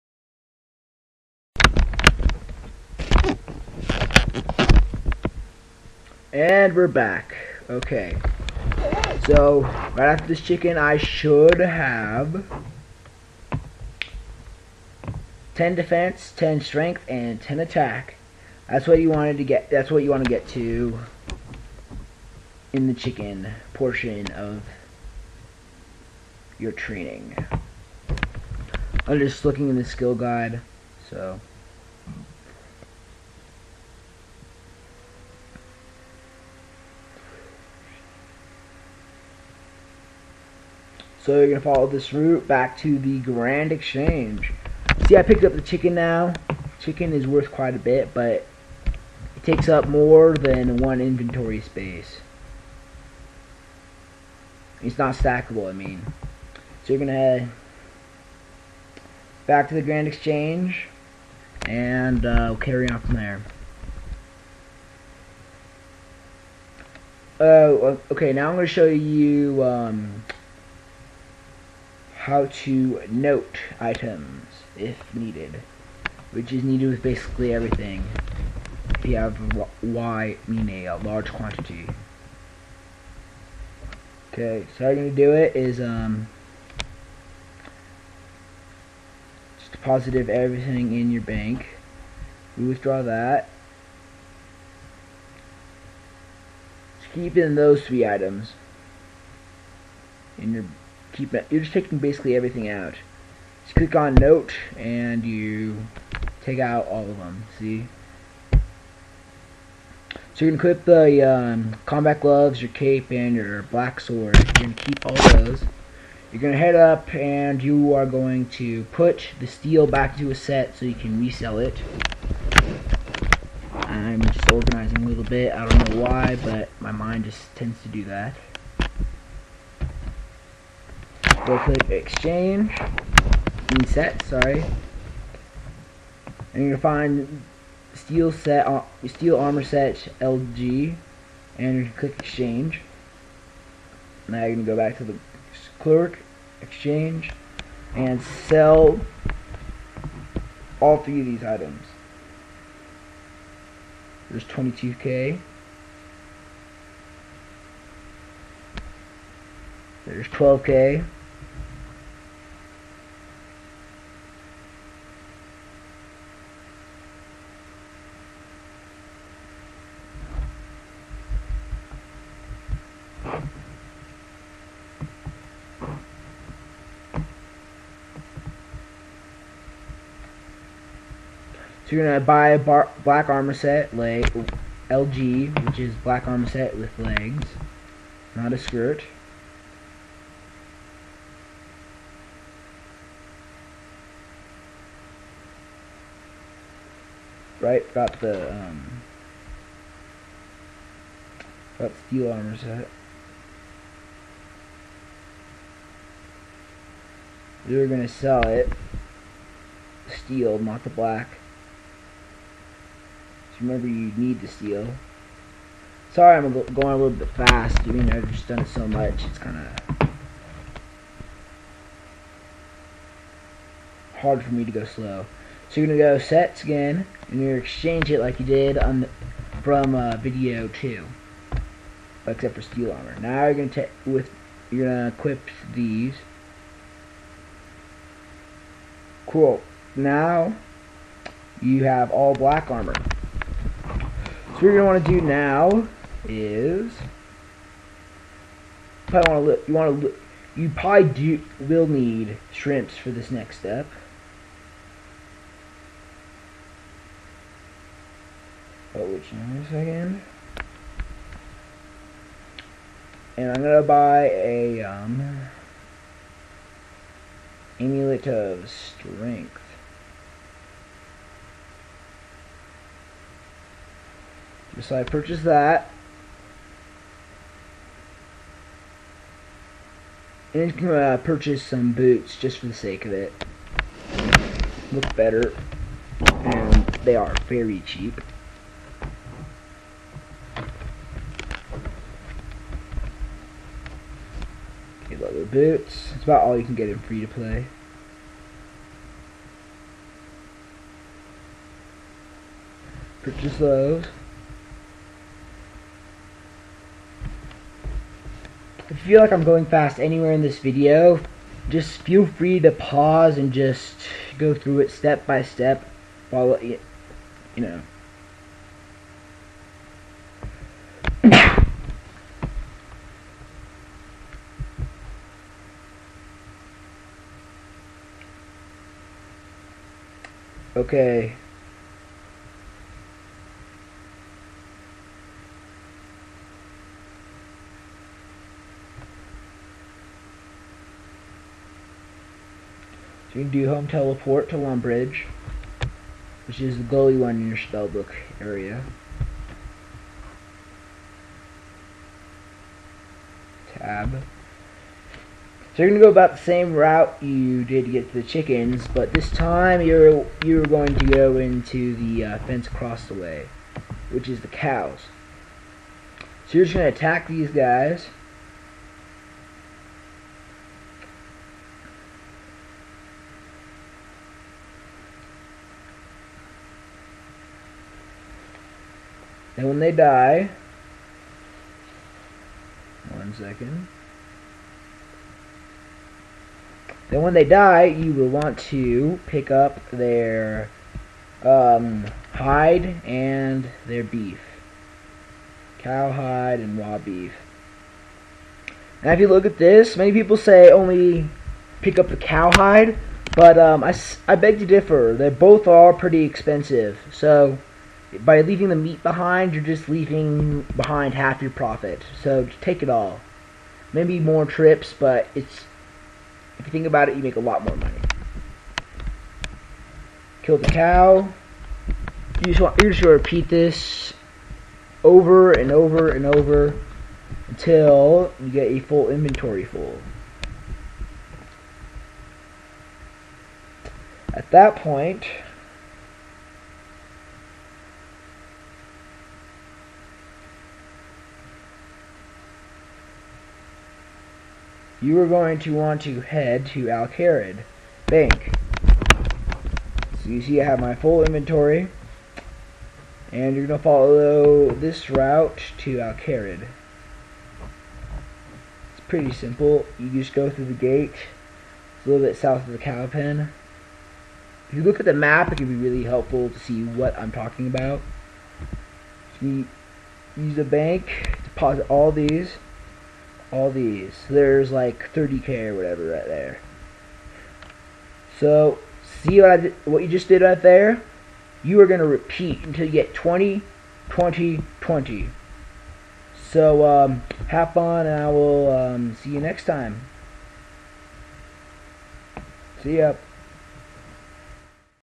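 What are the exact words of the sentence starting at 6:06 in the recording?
So you're just gonna attack these guys.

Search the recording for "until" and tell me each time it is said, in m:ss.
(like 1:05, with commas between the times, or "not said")
7:07, 8:02.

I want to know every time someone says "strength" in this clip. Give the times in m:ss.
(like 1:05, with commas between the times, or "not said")
0:16, 4:28.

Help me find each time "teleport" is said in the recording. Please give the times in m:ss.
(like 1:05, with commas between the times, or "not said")
5:43.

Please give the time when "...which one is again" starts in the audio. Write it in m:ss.
4:19.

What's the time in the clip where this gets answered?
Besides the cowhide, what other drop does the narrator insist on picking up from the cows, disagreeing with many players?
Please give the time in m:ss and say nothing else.
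6:36.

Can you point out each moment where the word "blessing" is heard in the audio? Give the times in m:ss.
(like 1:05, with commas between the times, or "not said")
not said.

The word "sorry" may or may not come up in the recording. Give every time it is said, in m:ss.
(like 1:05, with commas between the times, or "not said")
2:14, 3:36.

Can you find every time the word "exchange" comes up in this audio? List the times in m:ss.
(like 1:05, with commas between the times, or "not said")
0:43, 1:00, 2:11, 2:22, 2:26, 3:47.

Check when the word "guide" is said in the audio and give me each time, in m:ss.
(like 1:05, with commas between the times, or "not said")
0:30.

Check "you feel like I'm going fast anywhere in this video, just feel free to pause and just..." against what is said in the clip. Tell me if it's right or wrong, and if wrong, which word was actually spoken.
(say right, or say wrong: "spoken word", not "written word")
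right.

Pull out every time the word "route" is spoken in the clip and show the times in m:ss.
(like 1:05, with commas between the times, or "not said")
0:42, 5:56, 7:35.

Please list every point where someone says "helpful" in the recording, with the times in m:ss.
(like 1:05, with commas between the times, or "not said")
7:46.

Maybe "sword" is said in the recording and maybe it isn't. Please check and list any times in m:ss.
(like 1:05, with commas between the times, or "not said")
1:53.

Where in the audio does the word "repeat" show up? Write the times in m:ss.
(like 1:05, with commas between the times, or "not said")
7:03, 8:02.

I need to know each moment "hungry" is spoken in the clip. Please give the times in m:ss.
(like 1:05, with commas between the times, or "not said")
not said.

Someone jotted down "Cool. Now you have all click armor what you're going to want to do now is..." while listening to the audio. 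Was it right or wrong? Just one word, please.
wrong.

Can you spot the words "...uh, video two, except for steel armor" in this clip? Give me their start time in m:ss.
3:49.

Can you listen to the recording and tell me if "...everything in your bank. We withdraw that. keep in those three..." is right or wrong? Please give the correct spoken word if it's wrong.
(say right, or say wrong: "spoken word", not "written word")
right.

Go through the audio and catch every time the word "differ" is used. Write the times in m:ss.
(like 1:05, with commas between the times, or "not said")
6:44.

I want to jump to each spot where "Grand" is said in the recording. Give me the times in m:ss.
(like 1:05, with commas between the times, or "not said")
0:43, 0:59.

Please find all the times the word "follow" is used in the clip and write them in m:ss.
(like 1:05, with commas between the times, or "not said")
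0:41, 5:16, 7:33.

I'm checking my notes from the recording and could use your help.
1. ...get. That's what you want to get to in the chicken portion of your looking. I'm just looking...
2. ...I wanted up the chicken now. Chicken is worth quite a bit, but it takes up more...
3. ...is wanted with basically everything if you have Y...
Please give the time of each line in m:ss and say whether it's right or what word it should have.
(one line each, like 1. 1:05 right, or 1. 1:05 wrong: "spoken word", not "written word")
1. 0:19 wrong: "training", not "looking"
2. 0:45 wrong: "picked", not "wanted"
3. 1:16 wrong: "needed", not "wanted".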